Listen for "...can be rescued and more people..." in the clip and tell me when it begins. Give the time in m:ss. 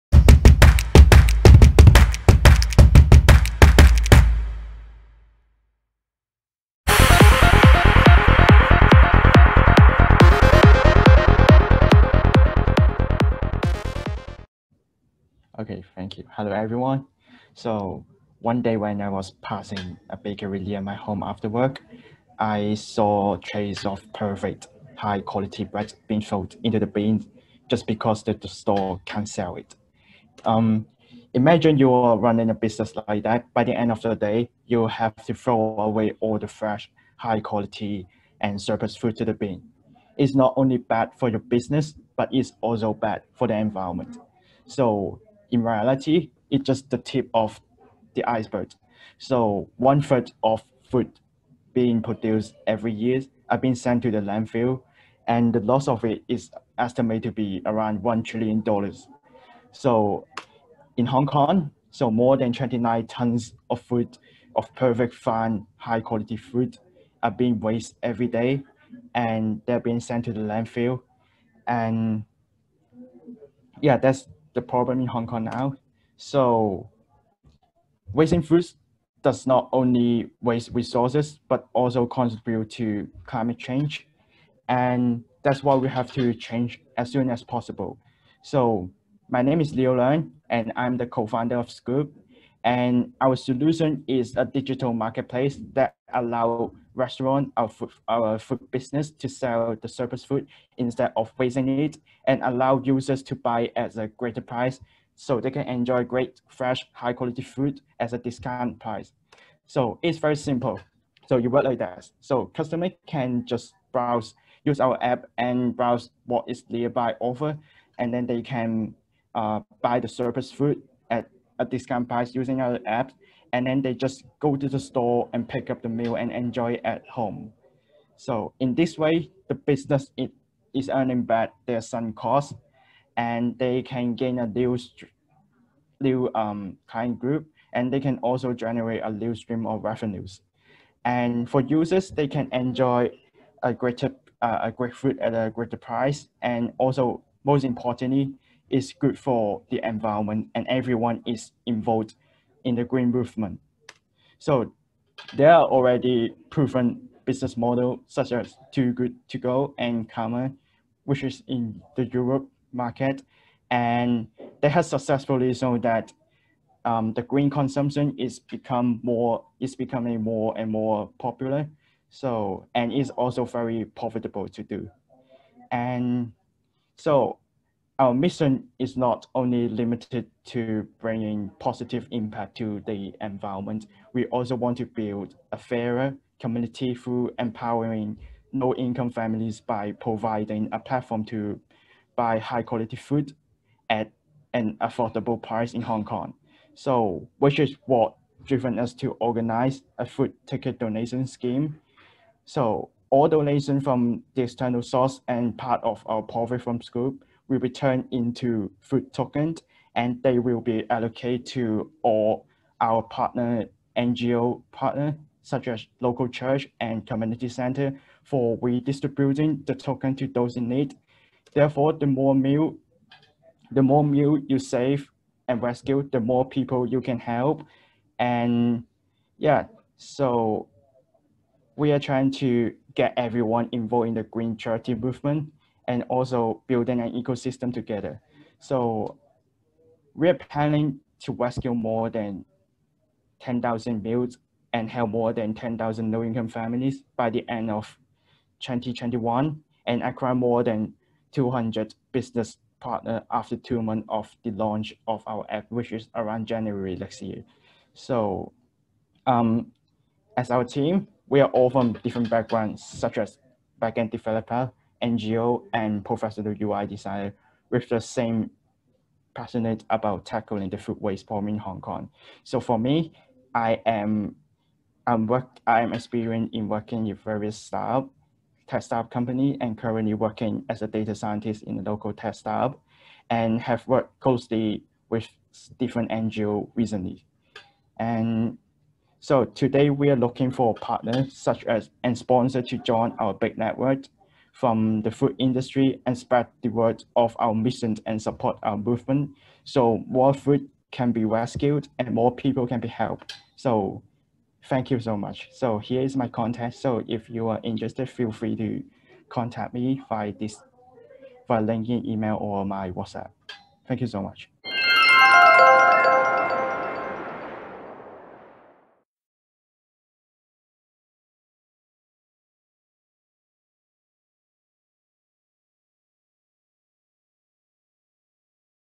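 5:00.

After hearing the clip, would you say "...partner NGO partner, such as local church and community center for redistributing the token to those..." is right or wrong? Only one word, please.
right.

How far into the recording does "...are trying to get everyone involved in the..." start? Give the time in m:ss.
3:51.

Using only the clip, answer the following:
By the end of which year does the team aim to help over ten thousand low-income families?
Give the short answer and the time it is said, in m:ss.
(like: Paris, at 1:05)
2021, at 4:08.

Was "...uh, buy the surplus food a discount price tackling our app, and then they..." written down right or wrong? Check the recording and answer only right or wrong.
wrong.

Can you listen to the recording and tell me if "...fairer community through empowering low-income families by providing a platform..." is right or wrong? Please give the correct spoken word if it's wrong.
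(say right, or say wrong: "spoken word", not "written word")
right.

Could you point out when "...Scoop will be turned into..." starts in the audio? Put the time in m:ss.
3:26.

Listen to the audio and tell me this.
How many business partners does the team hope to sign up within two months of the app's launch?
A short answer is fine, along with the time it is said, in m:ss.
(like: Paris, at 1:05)
200, at 4:11.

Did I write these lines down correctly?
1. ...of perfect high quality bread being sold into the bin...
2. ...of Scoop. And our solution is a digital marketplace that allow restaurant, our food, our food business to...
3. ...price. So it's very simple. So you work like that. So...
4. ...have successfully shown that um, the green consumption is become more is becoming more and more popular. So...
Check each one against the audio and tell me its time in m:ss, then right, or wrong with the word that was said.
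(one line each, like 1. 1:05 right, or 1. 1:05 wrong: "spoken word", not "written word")
1. 0:23 right
2. 1:31 right
3. 1:48 right
4. 2:44 right.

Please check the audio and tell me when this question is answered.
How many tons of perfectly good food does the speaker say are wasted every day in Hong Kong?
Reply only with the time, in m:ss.
1:02.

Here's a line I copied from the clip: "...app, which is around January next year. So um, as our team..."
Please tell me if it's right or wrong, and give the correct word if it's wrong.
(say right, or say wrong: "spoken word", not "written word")
right.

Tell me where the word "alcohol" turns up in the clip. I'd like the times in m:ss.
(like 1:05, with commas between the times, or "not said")
not said.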